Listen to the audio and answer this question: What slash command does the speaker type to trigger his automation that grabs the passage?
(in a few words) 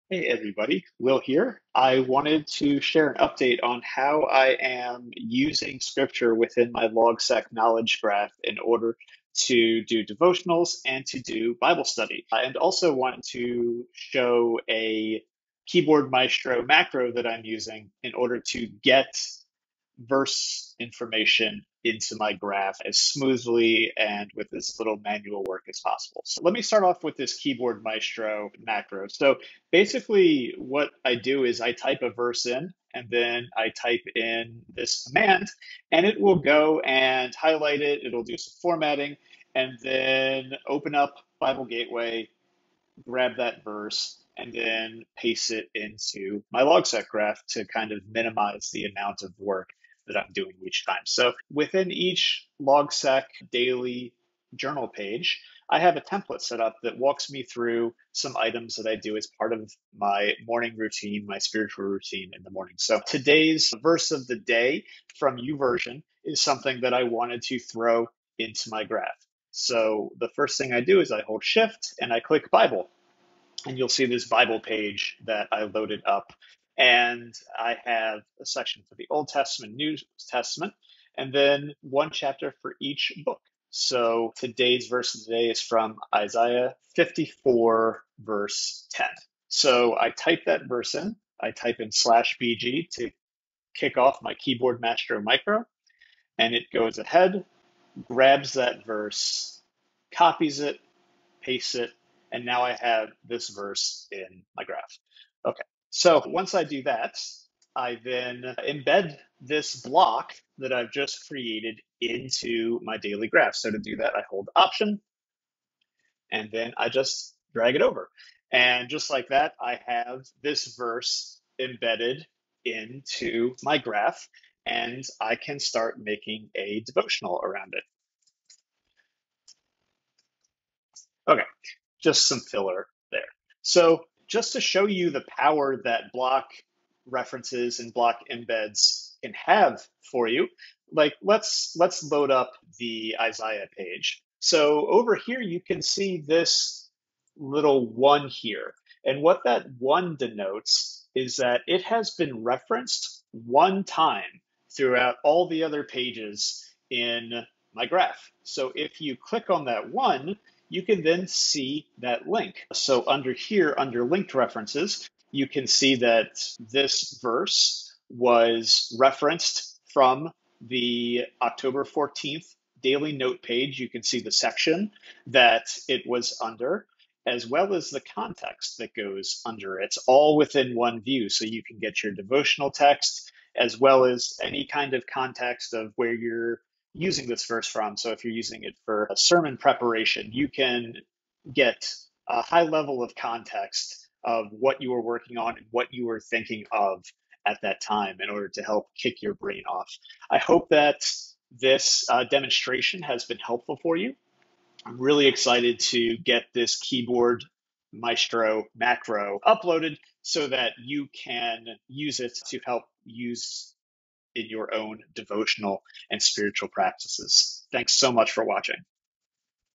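/BG.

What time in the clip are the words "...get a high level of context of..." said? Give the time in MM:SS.
03:11.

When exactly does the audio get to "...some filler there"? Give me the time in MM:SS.
02:12.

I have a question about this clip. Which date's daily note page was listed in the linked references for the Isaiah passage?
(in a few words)
October 14th.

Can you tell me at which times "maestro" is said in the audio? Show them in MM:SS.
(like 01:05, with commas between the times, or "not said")
00:16, 00:27, 01:34, 03:27.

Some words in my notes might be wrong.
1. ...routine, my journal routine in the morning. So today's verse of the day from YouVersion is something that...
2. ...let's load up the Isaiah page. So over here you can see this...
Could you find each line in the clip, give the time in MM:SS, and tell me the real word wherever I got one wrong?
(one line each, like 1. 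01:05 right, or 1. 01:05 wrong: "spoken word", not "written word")
1. 01:00 wrong: "spiritual", not "journal"
2. 02:21 right.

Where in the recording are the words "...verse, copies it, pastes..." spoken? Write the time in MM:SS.
01:38.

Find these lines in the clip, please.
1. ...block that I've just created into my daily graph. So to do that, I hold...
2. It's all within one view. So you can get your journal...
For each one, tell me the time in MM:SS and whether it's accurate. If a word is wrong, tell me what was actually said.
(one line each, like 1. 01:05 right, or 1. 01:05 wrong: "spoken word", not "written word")
1. 01:49 right
2. 02:59 wrong: "devotional", not "journal".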